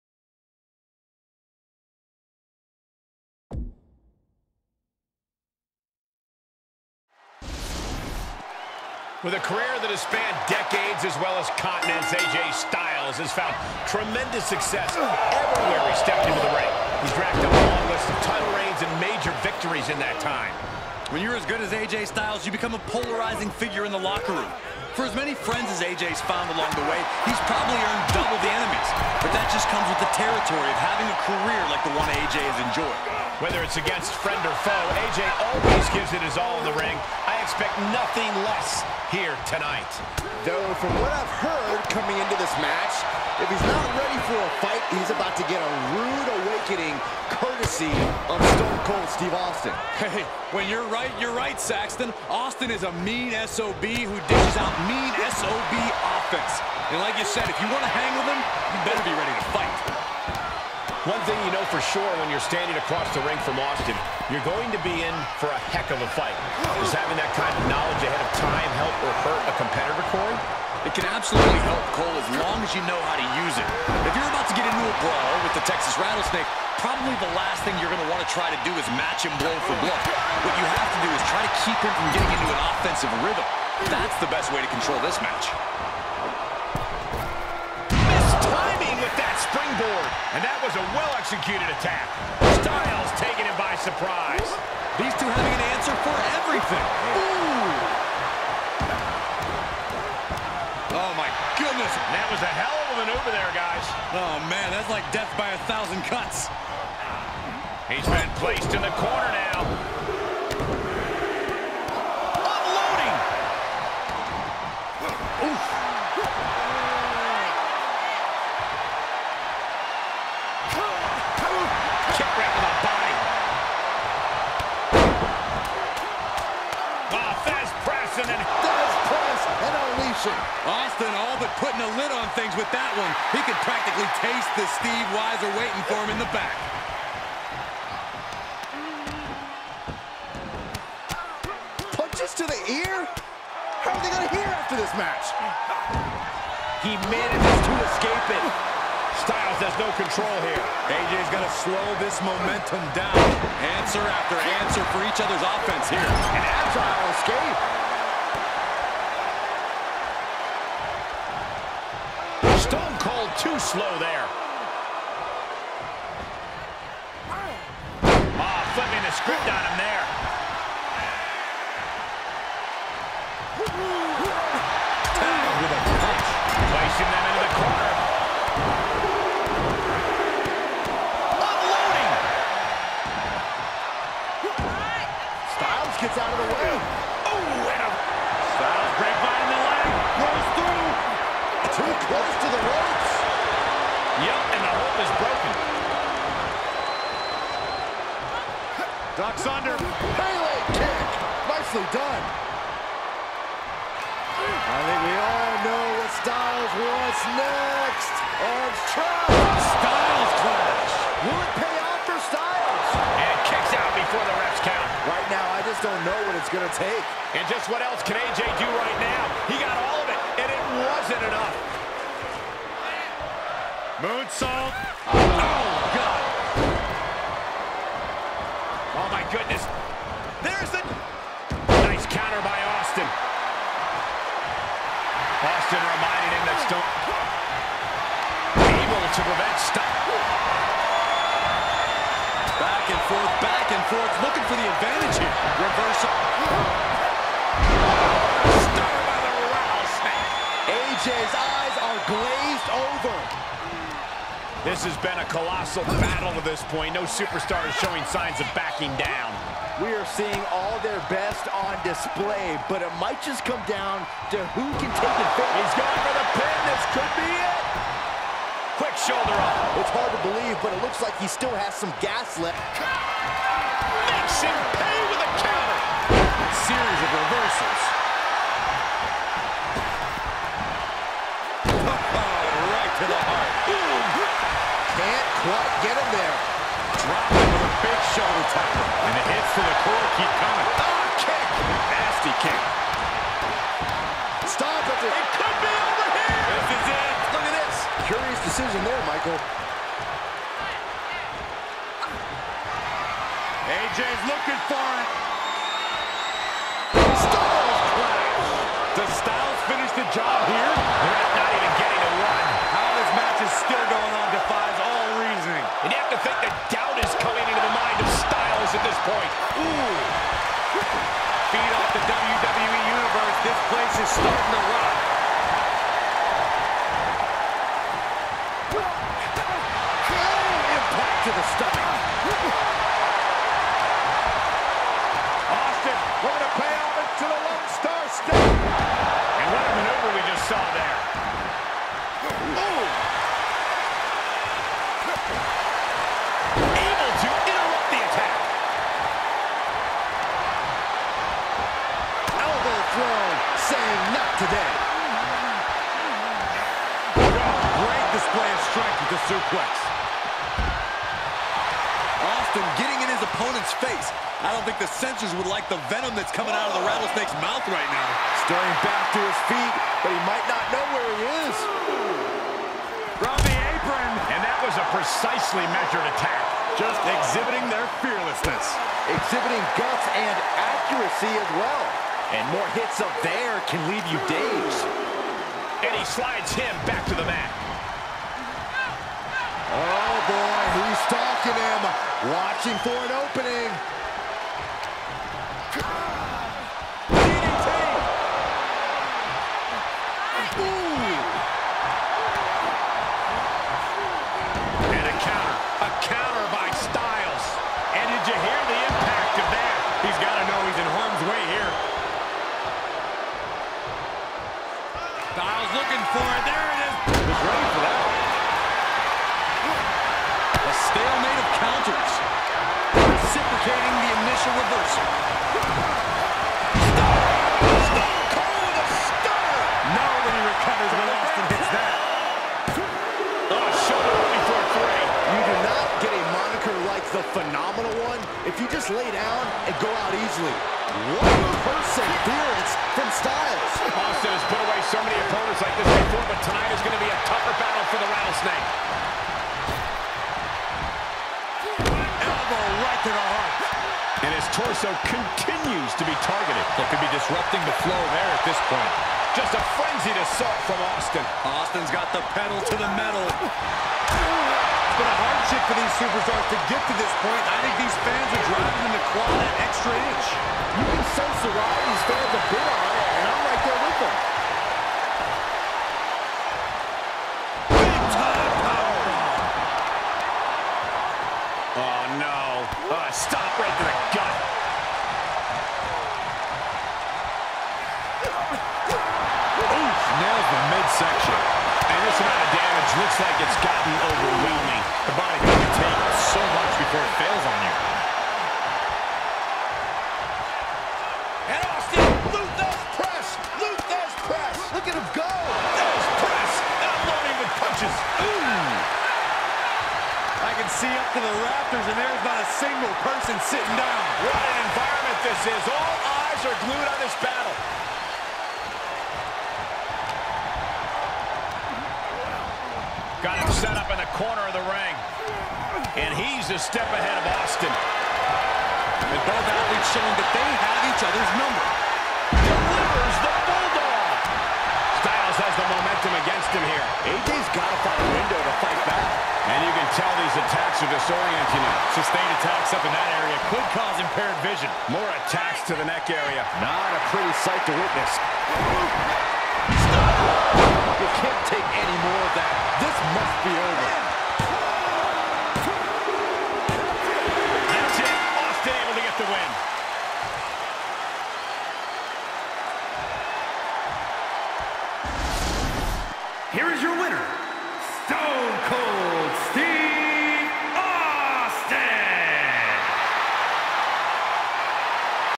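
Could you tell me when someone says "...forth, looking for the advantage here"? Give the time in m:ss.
4:03.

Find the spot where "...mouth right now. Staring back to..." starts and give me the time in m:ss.
6:07.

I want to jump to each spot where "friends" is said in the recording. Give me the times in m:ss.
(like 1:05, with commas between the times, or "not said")
0:25, 0:34.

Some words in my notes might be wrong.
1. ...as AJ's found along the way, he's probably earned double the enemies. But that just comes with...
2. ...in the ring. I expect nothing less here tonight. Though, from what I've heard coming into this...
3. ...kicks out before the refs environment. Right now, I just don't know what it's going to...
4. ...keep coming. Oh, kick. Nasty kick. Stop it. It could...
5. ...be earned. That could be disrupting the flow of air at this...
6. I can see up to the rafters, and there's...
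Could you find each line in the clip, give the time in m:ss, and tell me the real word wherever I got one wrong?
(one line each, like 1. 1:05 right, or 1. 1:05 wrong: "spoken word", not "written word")
1. 0:25 right
2. 0:36 right
3. 3:33 wrong: "count", not "environment"
4. 4:50 right
5. 7:36 wrong: "targeted", not "earned"
6. 8:30 right.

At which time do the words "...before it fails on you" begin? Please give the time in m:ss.
8:16.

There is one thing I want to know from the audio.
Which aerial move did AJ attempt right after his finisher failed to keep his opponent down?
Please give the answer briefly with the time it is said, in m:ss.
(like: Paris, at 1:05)
Moonsault, at 3:44.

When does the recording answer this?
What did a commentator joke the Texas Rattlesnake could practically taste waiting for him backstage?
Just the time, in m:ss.
2:14.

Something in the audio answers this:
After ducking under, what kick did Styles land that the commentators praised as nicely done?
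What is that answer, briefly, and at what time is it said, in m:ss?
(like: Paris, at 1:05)
Pelé kick, at 3:20.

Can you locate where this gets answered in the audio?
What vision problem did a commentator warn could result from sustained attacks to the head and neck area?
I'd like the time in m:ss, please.
9:04.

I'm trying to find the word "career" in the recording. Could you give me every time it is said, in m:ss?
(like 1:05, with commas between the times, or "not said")
0:09, 0:31.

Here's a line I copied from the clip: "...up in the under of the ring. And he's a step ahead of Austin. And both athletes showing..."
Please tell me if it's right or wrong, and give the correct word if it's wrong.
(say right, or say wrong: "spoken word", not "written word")
wrong: "corner", not "under".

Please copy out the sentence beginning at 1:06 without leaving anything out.
Does having that kind of knowledge ahead of time help or hurt a competitor, Corey?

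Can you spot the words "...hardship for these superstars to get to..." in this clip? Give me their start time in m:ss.
7:45.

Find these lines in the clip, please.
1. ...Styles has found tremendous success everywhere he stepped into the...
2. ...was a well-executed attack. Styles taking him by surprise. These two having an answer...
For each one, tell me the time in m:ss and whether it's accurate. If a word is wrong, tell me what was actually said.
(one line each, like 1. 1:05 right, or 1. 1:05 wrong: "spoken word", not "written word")
1. 0:12 right
2. 1:30 right.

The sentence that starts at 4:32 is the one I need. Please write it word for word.
Makes him pay with a counter.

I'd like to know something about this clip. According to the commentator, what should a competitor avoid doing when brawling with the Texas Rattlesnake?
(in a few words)
Match him blow for blow.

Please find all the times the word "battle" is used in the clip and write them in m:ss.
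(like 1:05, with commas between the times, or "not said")
4:15, 7:27, 8:37.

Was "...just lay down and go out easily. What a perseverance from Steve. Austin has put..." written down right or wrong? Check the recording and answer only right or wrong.
wrong.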